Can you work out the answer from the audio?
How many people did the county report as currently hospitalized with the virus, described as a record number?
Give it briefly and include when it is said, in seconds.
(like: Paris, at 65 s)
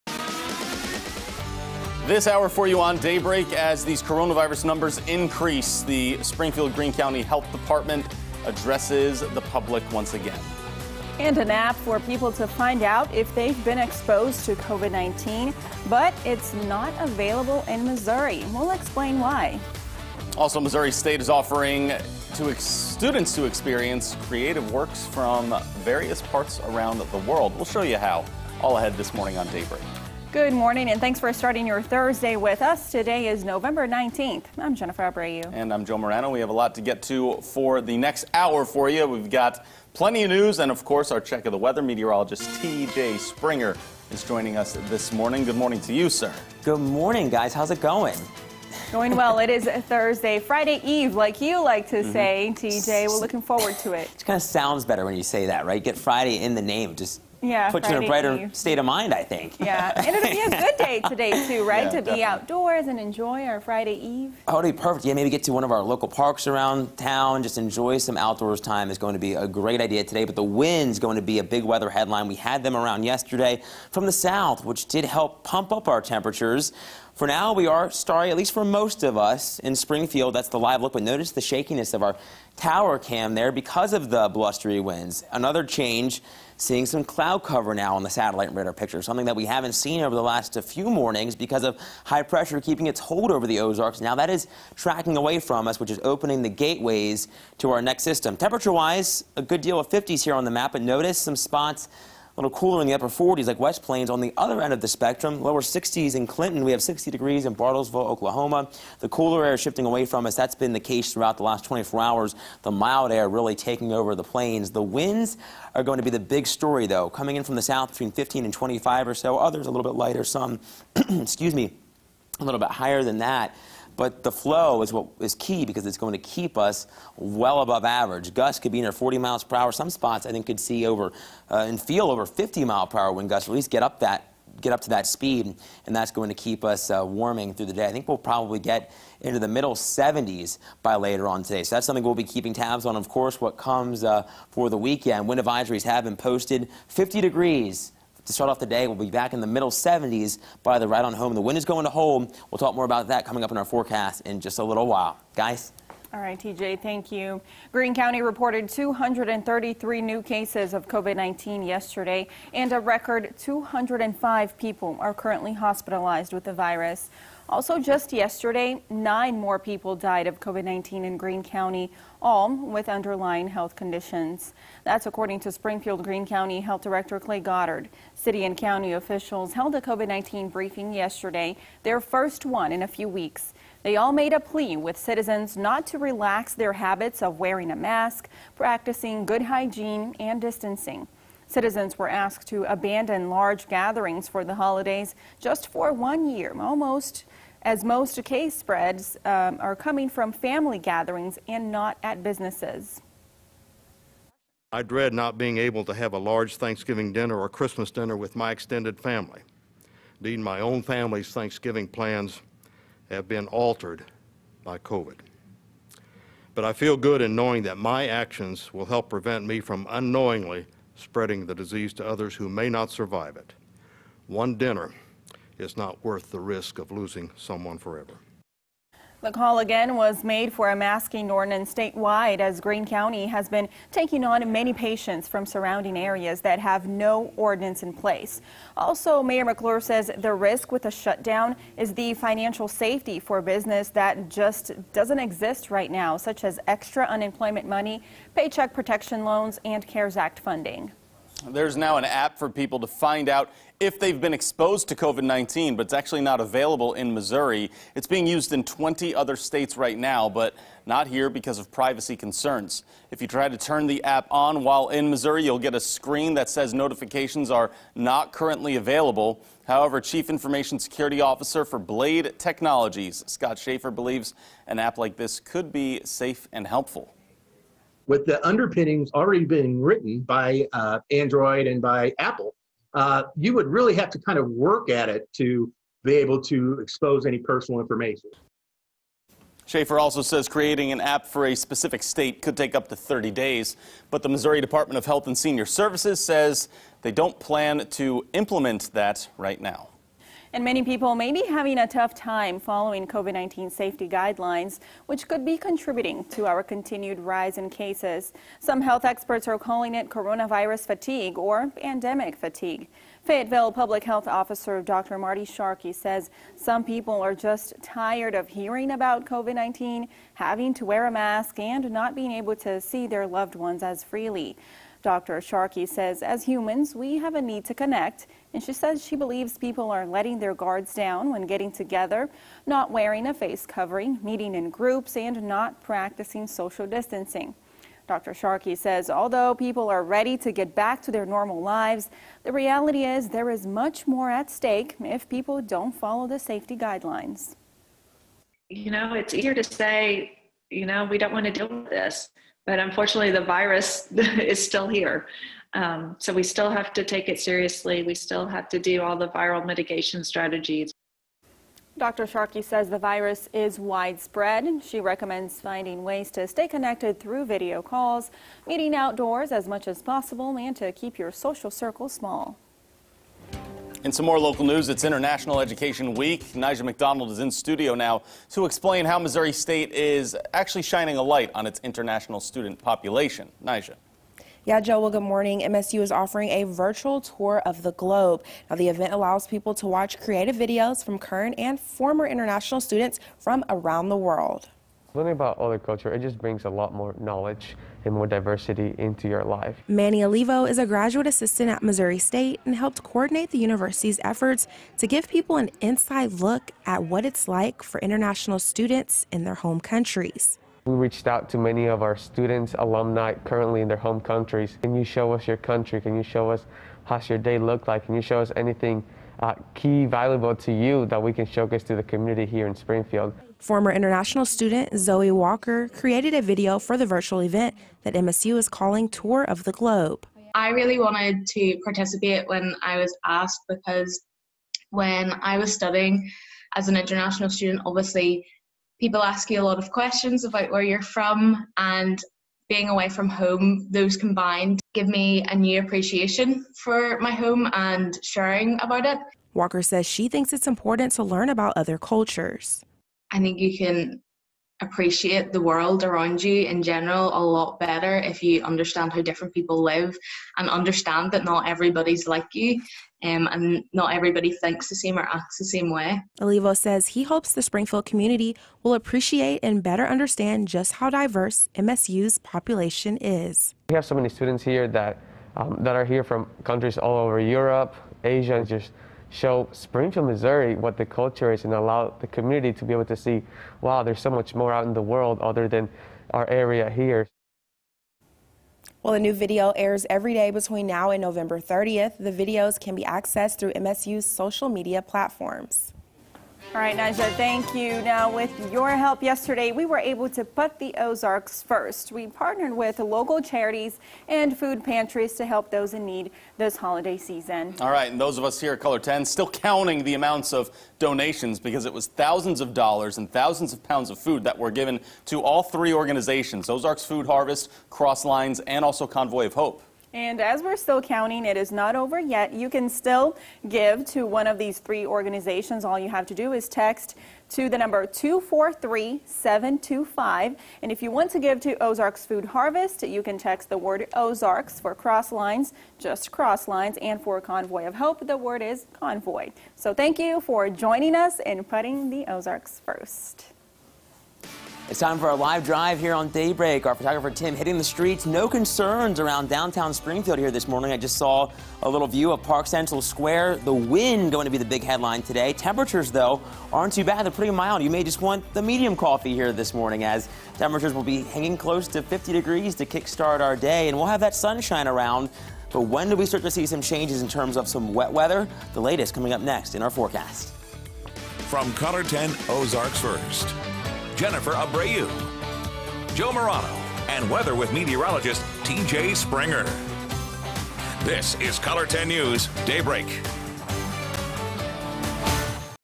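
205, at 163 s.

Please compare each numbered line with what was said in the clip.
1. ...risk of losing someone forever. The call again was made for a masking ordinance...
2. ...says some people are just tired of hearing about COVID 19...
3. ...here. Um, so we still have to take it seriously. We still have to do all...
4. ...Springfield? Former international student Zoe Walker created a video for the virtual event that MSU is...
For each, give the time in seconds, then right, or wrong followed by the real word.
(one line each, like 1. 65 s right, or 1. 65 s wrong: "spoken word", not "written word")
1. 226 s right
2. 315 s right
3. 354 s right
4. 422 s right.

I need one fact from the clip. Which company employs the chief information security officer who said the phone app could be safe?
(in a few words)
Blade Technologies.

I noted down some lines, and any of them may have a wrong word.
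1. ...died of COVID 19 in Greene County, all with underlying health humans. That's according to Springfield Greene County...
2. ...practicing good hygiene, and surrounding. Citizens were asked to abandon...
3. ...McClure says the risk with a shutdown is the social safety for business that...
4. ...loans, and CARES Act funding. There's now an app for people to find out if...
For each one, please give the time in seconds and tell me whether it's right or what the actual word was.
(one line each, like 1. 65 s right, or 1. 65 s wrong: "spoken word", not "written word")
1. 169 s wrong: "conditions", not "humans"
2. 188 s wrong: "distancing", not "surrounding"
3. 239 s wrong: "financial", not "social"
4. 249 s right.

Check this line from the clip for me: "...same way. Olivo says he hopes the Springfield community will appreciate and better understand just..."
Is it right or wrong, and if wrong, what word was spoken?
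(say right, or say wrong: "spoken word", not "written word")
right.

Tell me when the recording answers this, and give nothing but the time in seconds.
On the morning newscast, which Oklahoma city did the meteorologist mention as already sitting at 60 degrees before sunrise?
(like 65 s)
107 s.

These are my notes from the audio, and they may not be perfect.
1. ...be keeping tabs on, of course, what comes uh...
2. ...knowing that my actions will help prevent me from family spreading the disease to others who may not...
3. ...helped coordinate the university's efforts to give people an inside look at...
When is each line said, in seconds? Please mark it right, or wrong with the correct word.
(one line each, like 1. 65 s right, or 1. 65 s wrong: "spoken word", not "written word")
1. 142 s right
2. 217 s wrong: "unknowingly", not "family"
3. 402 s right.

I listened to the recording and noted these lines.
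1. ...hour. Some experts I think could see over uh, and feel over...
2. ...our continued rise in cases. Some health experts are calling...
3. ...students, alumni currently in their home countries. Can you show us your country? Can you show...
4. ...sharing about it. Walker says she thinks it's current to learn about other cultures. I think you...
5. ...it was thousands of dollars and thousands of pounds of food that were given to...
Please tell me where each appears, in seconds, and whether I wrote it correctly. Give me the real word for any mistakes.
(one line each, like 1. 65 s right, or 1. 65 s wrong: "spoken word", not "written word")
1. 129 s wrong: "spots", not "experts"
2. 306 s right
3. 412 s right
4. 448 s wrong: "important", not "current"
5. 511 s right.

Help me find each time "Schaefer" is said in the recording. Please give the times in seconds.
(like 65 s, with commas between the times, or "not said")
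273 s, 289 s.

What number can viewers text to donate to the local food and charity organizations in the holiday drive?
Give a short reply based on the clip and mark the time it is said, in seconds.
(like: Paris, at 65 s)
243725, at 528 s.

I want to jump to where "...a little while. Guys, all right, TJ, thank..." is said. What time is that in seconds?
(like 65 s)
154 s.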